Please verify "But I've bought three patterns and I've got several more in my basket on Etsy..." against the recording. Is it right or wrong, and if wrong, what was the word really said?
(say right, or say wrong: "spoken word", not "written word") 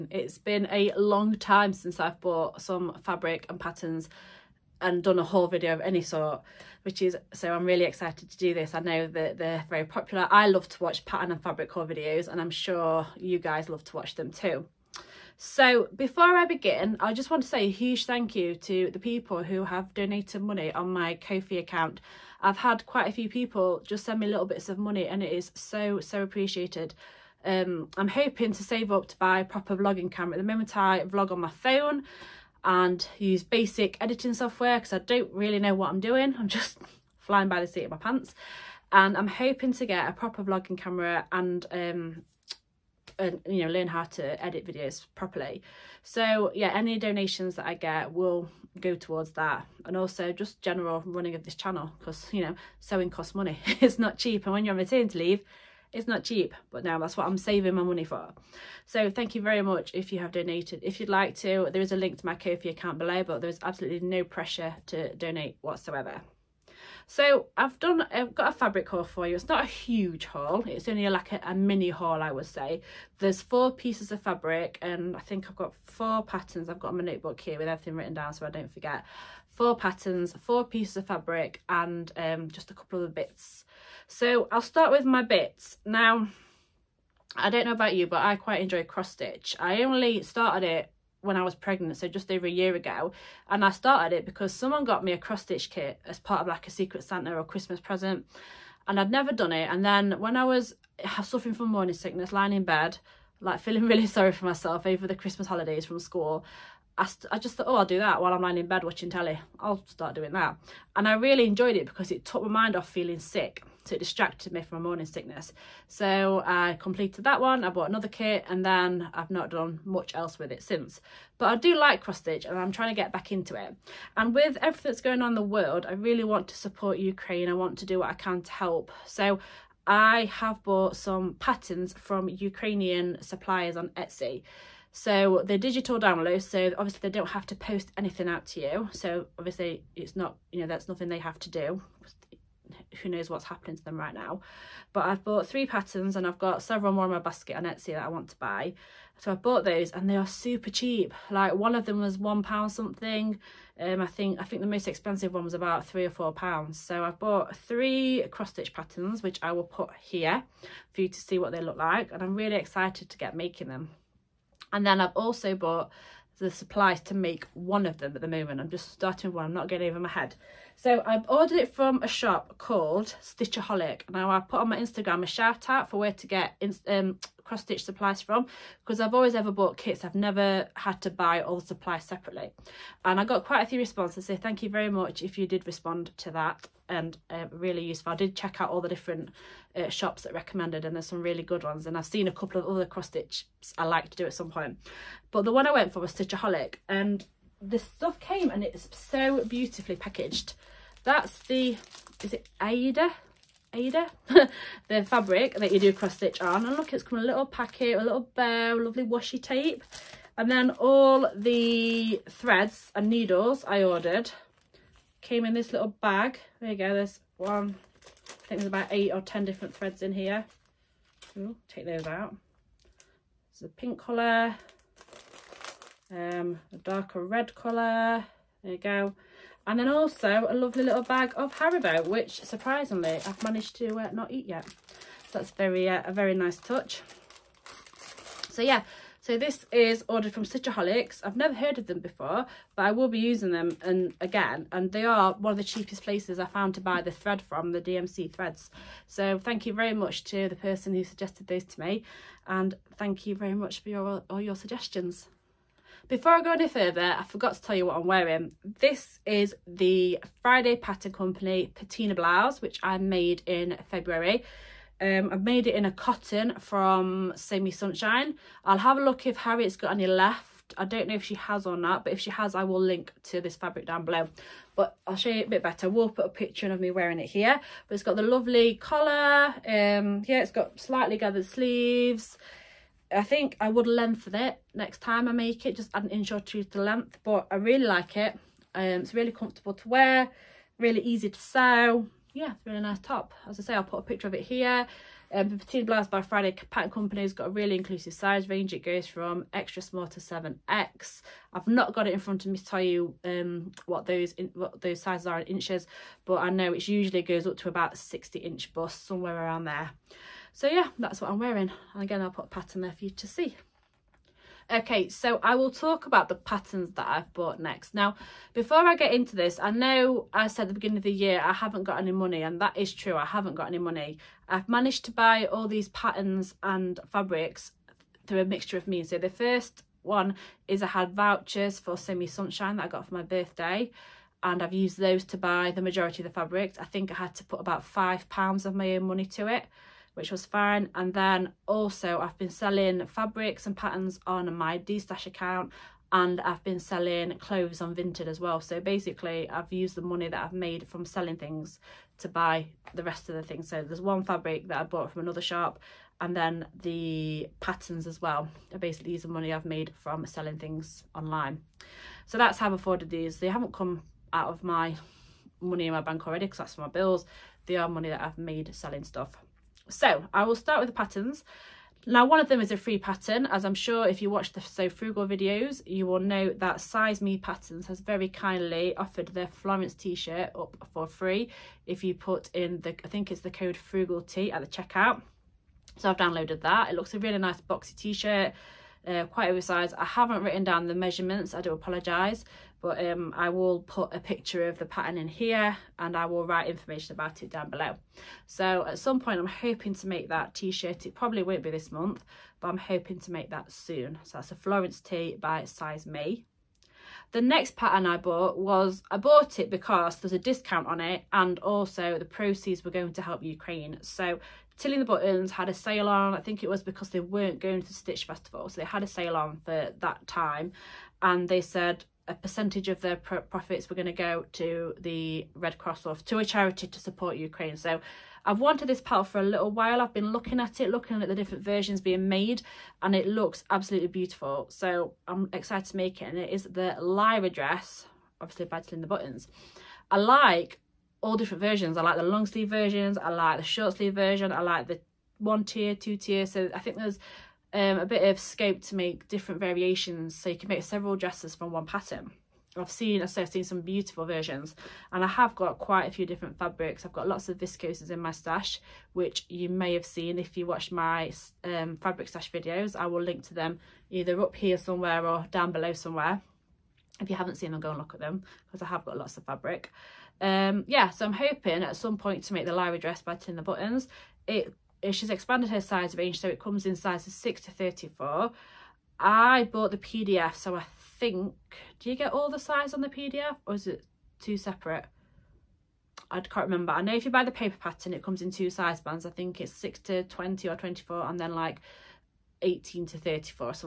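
right.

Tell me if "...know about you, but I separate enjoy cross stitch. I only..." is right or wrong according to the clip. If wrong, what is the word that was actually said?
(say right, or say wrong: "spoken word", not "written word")
wrong: "quite", not "separate".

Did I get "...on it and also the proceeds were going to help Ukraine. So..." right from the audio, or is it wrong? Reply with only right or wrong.
right.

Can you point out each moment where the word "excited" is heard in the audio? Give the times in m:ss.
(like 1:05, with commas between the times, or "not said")
0:07, 2:42, 7:15.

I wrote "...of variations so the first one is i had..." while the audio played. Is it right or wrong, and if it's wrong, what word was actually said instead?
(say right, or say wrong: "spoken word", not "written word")
wrong: "means", not "variations".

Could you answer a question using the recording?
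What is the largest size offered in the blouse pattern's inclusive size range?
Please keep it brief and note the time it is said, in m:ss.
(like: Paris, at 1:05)
7X, at 5:00.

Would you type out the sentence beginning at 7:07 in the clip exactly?
So I've wanted this palette for a little while.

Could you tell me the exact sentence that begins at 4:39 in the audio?
Um, yeah, it's got slightly gathered sleeves.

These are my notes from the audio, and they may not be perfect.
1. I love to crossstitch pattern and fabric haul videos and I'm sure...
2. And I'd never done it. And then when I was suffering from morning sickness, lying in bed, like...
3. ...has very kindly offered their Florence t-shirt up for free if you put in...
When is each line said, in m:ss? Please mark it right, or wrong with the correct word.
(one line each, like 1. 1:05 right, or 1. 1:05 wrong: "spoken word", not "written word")
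1. 0:10 wrong: "watch", not "crossstitch"
2. 1:38 right
3. 6:17 right.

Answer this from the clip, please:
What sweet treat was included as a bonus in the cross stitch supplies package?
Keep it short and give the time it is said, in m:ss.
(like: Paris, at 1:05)
Haribo, at 3:51.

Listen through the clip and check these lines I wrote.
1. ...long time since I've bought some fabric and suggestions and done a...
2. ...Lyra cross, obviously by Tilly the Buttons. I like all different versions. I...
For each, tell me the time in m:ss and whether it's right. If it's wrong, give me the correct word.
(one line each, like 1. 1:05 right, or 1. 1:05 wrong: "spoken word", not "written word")
1. 0:00 wrong: "patterns", not "suggestions"
2. 7:16 wrong: "dress", not "cross".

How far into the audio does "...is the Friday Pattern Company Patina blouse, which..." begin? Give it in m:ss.
4:19.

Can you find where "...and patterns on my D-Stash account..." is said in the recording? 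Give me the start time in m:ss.
5:43.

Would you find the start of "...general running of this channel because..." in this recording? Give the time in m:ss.
0:50.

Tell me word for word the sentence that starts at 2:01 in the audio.
But I do like cross stitch and I'm trying to get back into it.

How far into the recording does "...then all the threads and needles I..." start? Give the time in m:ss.
3:30.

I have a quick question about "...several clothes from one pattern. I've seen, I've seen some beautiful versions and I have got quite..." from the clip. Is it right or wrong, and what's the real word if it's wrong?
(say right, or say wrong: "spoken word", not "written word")
wrong: "dresses", not "clothes".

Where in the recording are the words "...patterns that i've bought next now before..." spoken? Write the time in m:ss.
5:16.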